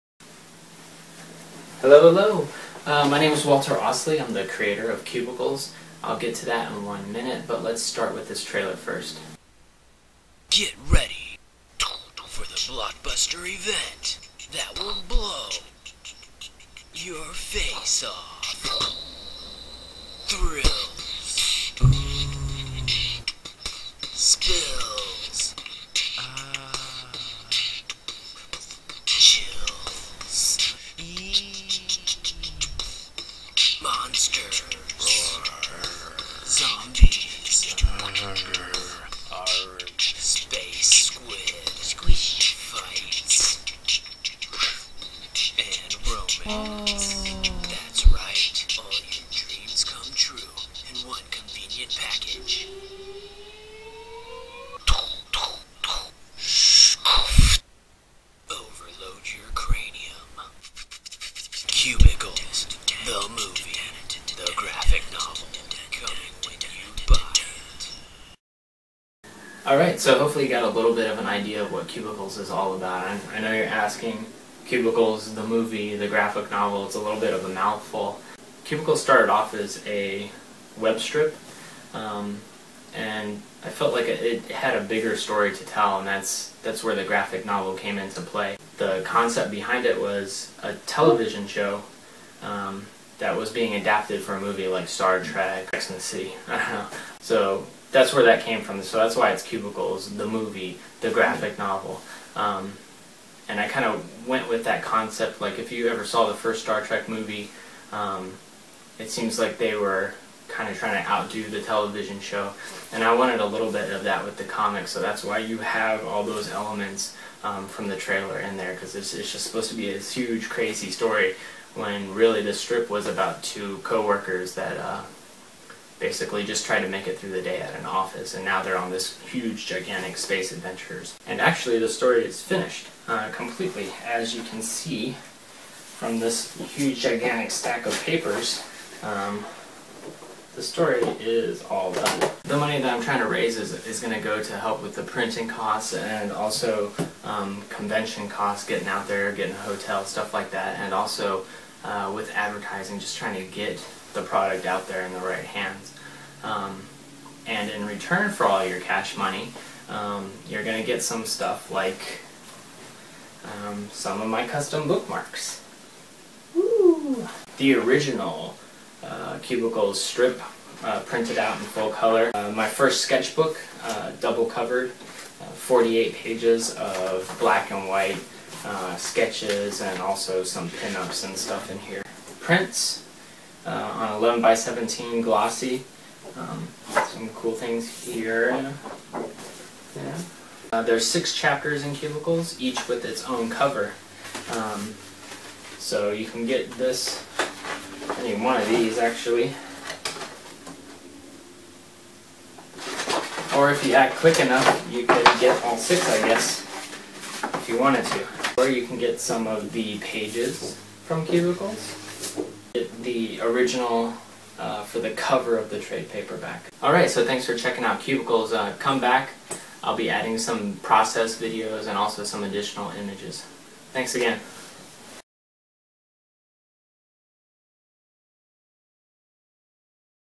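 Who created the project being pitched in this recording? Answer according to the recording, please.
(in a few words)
Walter Osley.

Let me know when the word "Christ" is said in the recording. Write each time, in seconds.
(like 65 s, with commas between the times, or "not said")
not said.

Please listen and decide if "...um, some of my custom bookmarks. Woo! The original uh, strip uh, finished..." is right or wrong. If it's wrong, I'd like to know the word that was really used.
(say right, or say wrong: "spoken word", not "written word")
wrong: "printed", not "finished".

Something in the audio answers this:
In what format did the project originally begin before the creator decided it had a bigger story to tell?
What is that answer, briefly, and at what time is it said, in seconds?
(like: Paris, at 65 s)
web strip, at 80 s.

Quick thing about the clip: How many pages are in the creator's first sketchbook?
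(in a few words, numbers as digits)
48.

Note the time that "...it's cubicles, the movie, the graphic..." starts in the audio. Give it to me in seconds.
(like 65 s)
99 s.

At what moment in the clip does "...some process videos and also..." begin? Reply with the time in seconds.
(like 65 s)
220 s.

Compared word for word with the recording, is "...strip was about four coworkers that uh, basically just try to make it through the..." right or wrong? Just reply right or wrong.
wrong.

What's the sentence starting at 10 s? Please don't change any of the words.
Get ready for the blockbuster event that will blow your face off.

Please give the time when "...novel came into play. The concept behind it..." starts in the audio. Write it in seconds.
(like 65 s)
87 s.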